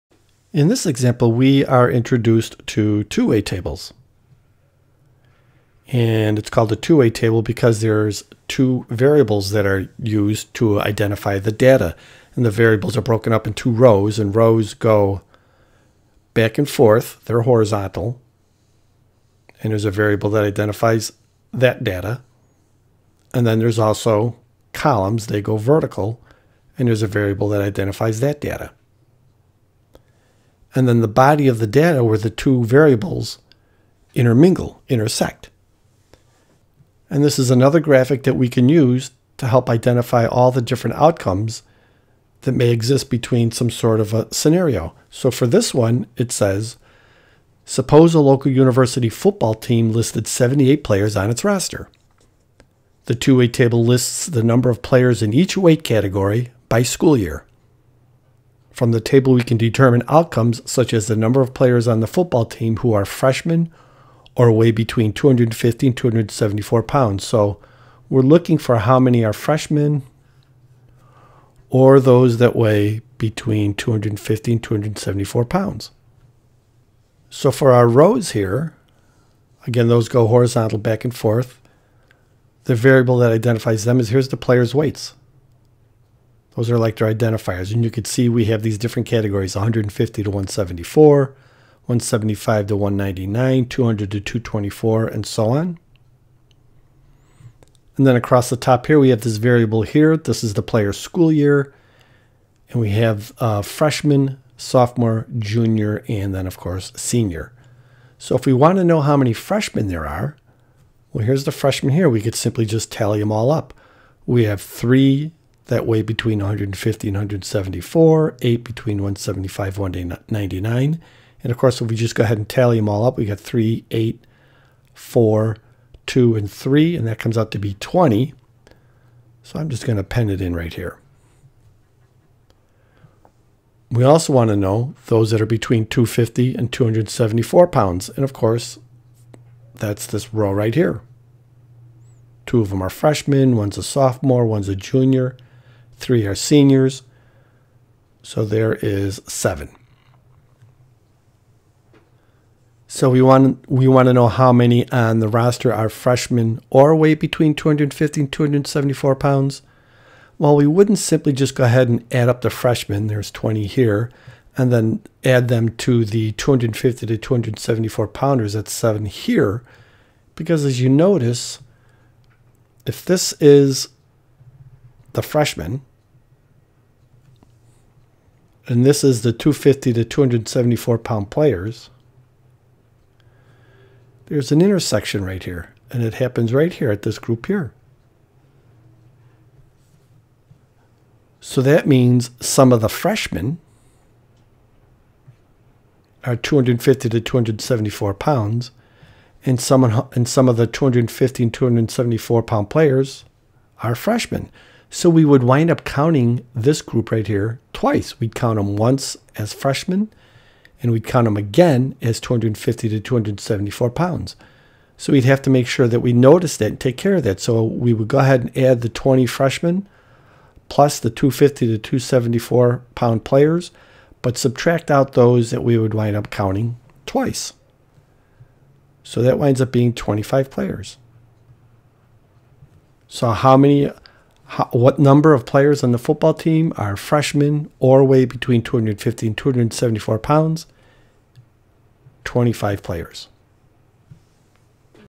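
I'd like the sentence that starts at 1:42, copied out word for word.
And we have uh, freshman, sophomore, junior, and then, of course, senior.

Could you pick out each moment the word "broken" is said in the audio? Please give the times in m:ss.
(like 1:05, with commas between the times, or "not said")
0:13.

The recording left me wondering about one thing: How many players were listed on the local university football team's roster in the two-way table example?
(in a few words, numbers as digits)
78.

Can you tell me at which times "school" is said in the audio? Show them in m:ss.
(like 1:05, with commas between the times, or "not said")
0:56, 1:40.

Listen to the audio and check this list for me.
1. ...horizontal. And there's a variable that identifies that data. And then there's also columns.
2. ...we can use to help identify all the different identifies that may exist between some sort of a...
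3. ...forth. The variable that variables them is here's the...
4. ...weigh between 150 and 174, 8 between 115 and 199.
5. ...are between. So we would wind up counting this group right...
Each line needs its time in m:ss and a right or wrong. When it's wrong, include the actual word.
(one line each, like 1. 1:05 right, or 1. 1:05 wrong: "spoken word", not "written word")
1. 0:17 right
2. 0:38 wrong: "outcomes", not "identifies"
3. 1:21 wrong: "identifies", not "variables"
4. 1:55 wrong: "175", not "115"
5. 3:23 wrong: "freshmen", not "between".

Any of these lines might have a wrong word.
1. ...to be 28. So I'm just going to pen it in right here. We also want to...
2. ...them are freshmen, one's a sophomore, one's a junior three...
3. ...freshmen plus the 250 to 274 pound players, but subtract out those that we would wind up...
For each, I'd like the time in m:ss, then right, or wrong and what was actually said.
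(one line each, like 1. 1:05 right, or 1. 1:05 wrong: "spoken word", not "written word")
1. 2:07 wrong: "20", not "28"
2. 2:22 right
3. 3:39 right.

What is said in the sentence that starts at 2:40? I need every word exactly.
Well, we wouldn't simply just go ahead and add up the freshmen.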